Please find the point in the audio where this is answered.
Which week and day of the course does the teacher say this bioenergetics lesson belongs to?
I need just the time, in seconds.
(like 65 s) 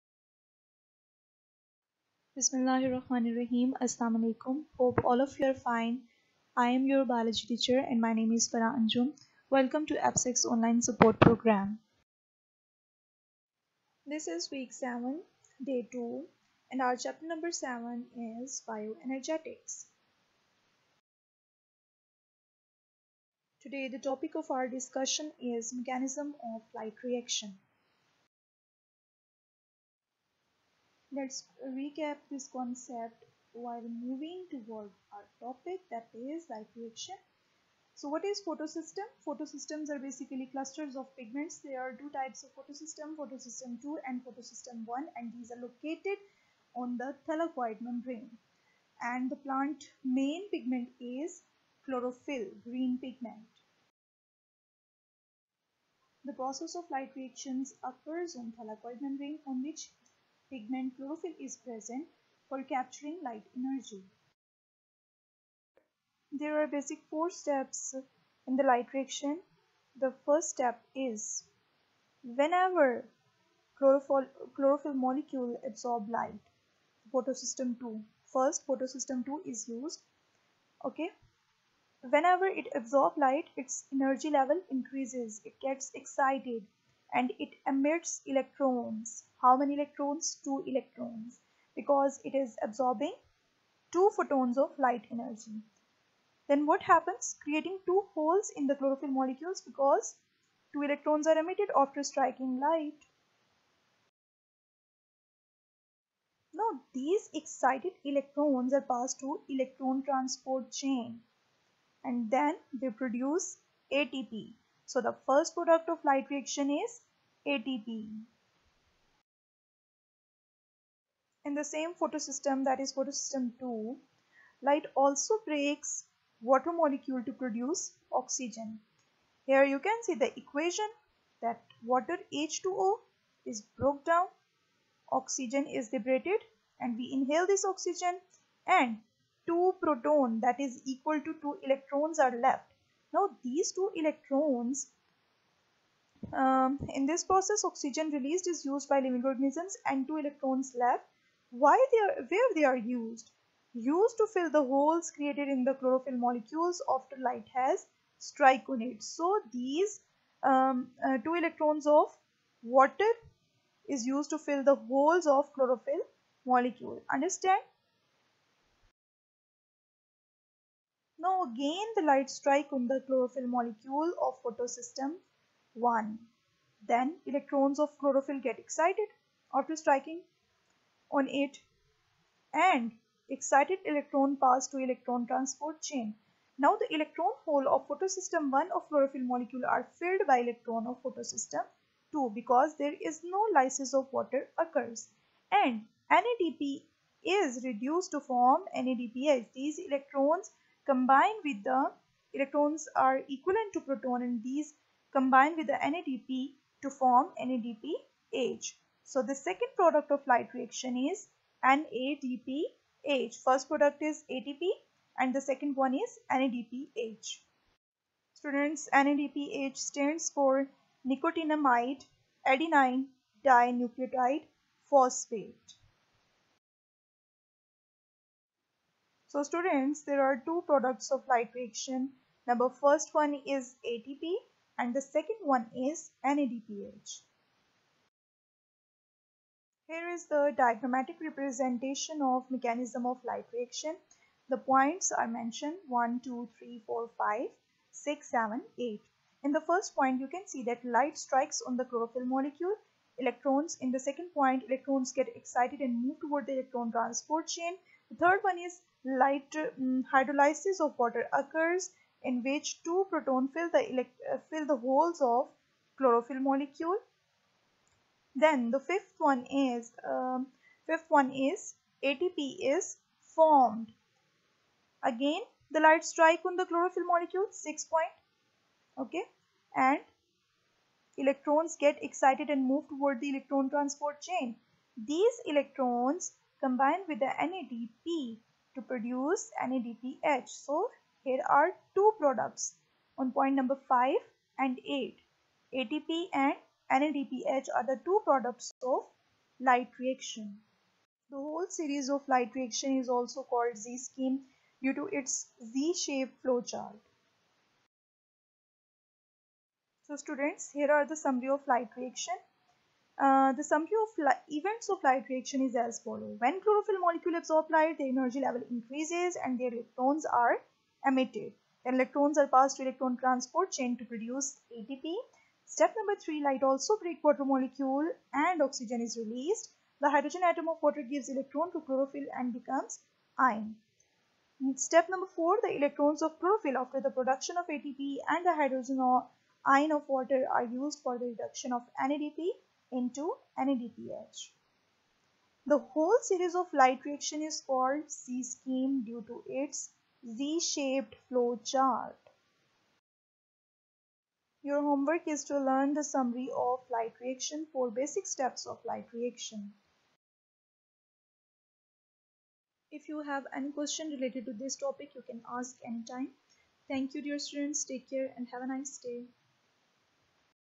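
14 s.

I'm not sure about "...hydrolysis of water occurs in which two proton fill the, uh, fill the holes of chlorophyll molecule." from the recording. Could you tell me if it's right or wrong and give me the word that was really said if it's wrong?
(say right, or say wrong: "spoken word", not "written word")
right.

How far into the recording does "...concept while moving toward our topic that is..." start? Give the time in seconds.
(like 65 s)
32 s.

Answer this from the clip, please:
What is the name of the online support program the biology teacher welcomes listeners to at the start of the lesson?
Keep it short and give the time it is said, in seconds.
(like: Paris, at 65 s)
APSAC, at 9 s.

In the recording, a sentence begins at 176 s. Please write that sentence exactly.
Then electrons of chlorophyll get excited after striking on it and excited electron pass to electron transport chain.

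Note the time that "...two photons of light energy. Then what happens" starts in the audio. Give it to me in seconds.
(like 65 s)
93 s.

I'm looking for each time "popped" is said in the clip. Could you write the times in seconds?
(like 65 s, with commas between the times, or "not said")
not said.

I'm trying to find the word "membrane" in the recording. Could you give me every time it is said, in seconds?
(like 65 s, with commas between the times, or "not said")
47 s, 59 s.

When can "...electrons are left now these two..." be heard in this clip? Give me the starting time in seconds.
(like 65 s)
141 s.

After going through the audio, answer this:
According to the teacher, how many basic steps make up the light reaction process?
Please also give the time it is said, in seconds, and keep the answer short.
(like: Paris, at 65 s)
4, at 67 s.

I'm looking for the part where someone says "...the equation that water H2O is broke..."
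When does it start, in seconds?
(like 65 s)
130 s.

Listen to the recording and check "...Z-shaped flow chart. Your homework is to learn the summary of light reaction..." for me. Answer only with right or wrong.
right.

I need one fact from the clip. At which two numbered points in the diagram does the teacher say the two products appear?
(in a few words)
5 and 8.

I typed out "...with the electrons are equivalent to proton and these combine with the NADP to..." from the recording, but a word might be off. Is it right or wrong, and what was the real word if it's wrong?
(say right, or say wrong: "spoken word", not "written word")
right.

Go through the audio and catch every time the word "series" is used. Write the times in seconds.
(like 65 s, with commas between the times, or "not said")
301 s, 346 s.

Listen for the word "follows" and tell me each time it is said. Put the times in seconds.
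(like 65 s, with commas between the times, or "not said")
315 s.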